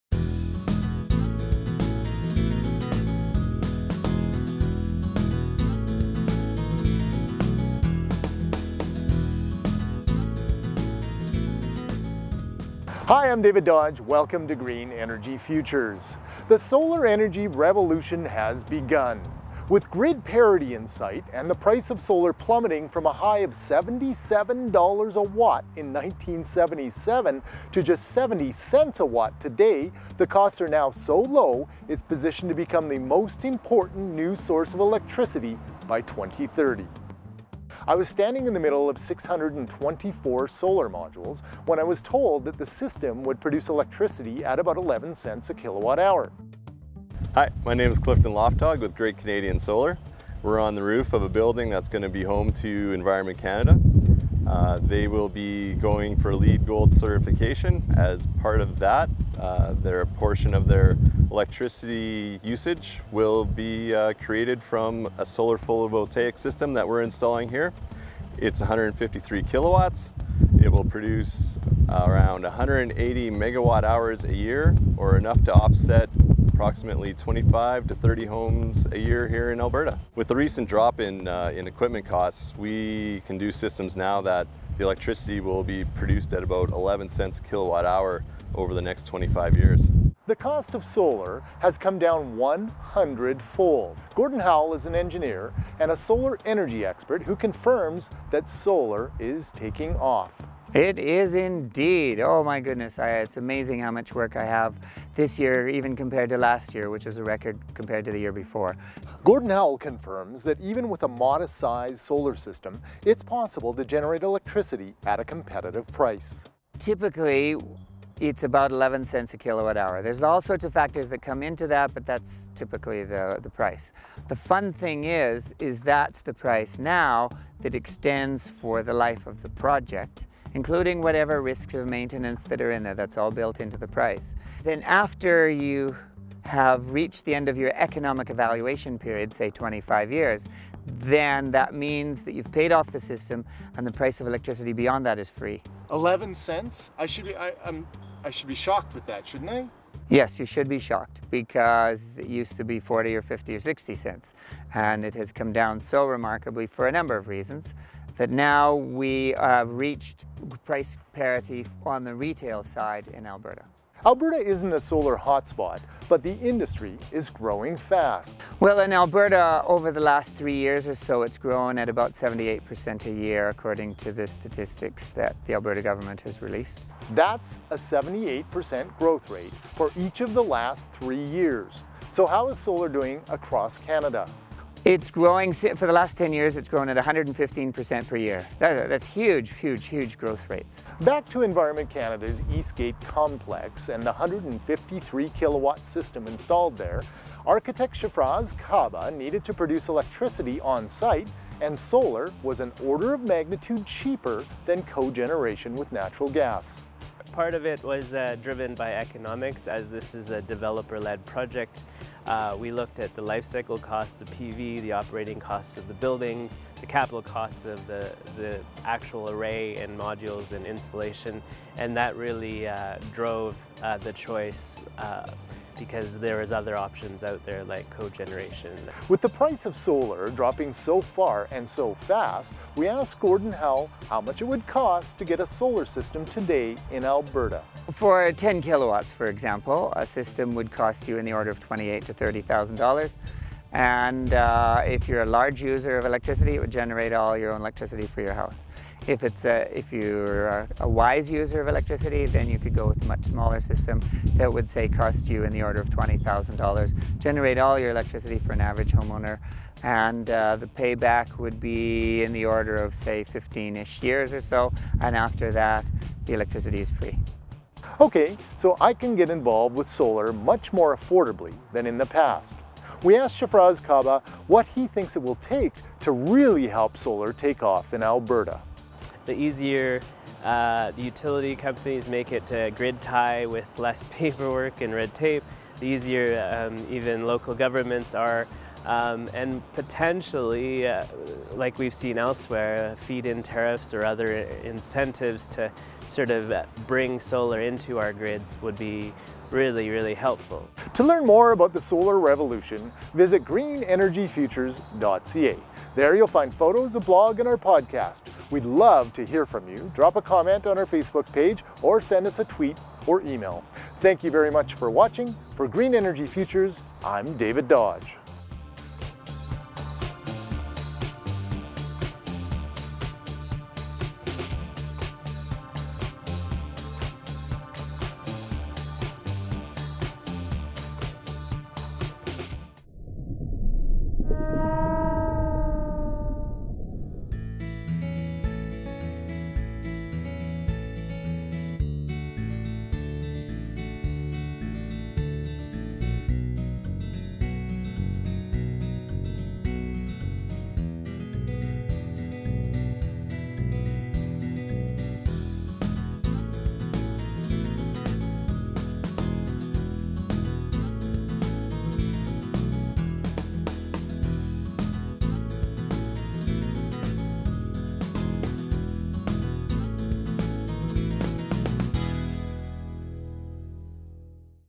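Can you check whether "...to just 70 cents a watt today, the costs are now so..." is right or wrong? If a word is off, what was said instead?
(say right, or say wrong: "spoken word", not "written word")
right.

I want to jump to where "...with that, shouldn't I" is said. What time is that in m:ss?
2:28.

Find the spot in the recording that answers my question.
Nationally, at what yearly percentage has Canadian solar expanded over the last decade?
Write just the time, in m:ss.
3:06.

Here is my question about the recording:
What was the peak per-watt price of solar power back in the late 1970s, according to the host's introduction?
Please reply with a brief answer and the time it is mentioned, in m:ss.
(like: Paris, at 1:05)
$77, at 0:23.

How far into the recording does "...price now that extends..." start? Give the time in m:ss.
2:06.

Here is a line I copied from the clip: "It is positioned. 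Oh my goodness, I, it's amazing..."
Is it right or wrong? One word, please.
wrong.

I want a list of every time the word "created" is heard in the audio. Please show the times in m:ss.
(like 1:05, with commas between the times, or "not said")
1:04.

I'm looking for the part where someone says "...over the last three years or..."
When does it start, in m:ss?
2:49.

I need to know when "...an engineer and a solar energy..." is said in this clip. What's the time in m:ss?
1:34.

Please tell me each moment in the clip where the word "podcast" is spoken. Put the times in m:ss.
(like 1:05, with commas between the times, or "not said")
5:07.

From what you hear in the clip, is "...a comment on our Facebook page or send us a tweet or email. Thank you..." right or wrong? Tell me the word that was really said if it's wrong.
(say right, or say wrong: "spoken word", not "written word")
right.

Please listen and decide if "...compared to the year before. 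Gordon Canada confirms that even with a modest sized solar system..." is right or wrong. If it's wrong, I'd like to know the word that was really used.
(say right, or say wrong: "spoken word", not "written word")
wrong: "Howell", not "Canada".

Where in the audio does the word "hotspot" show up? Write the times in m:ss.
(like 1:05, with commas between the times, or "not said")
2:45.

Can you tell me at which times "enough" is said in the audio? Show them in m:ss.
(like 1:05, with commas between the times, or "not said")
1:15.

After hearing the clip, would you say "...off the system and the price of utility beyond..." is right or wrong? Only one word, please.
wrong.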